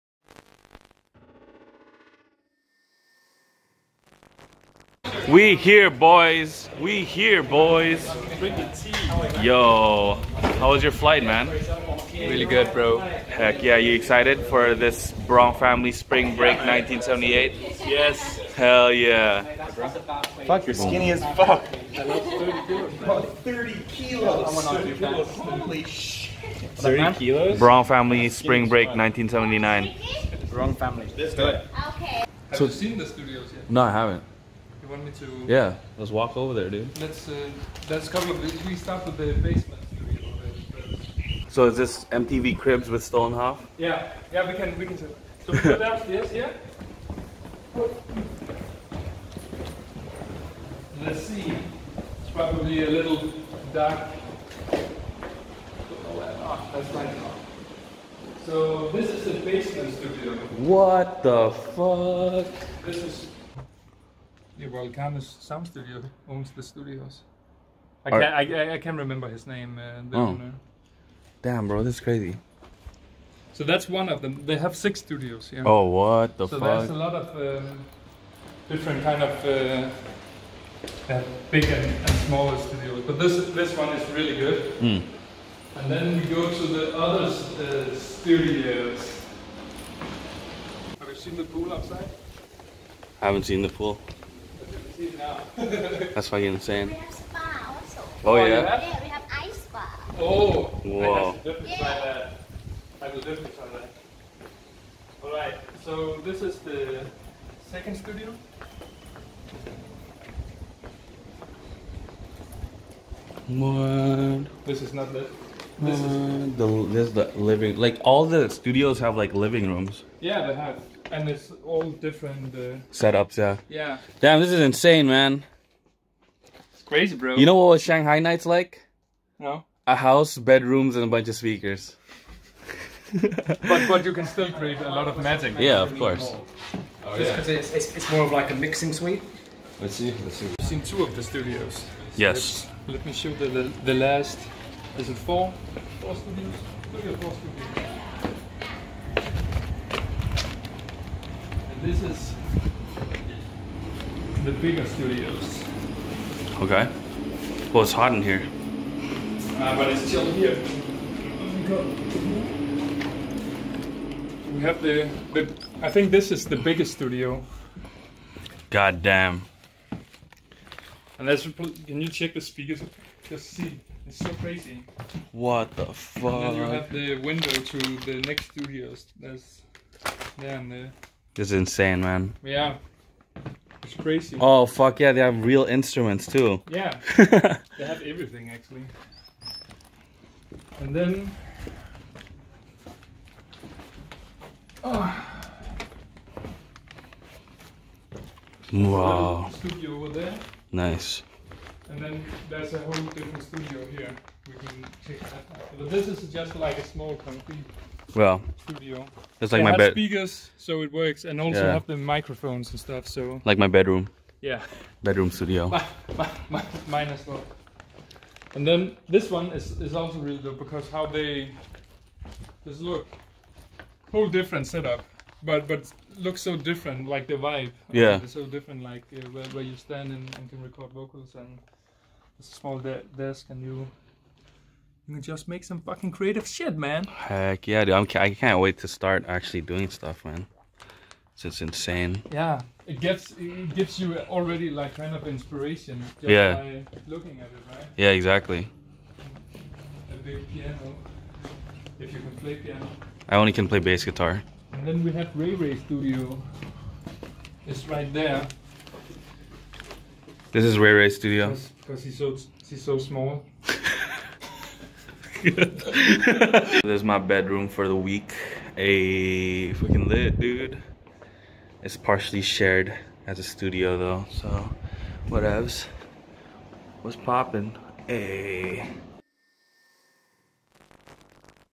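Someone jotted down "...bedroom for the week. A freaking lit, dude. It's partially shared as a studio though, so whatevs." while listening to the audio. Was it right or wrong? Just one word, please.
right.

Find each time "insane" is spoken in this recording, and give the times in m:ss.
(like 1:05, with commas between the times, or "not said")
1:36, 2:04, 3:01, 4:01.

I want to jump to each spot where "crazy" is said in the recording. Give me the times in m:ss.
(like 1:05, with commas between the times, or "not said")
1:12, 2:06, 2:54, 3:03.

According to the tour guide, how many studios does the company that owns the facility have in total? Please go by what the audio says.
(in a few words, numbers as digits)
6.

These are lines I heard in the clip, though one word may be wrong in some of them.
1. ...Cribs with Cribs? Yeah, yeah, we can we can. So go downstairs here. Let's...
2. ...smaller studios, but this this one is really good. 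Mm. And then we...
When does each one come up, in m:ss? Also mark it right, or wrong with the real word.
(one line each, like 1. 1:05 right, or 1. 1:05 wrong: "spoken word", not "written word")
1. 0:42 wrong: "Stoltenhoff", not "Cribs"
2. 1:22 right.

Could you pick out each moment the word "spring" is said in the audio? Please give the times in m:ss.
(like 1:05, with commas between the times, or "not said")
0:15, 0:28.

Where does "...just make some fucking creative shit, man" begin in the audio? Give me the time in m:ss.
3:55.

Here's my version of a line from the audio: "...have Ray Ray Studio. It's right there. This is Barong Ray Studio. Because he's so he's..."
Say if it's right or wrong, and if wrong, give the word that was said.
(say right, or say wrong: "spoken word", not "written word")
wrong: "Ray", not "Barong".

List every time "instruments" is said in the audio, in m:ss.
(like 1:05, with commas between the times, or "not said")
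3:05.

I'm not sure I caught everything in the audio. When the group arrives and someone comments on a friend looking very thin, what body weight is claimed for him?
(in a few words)
30 kilos.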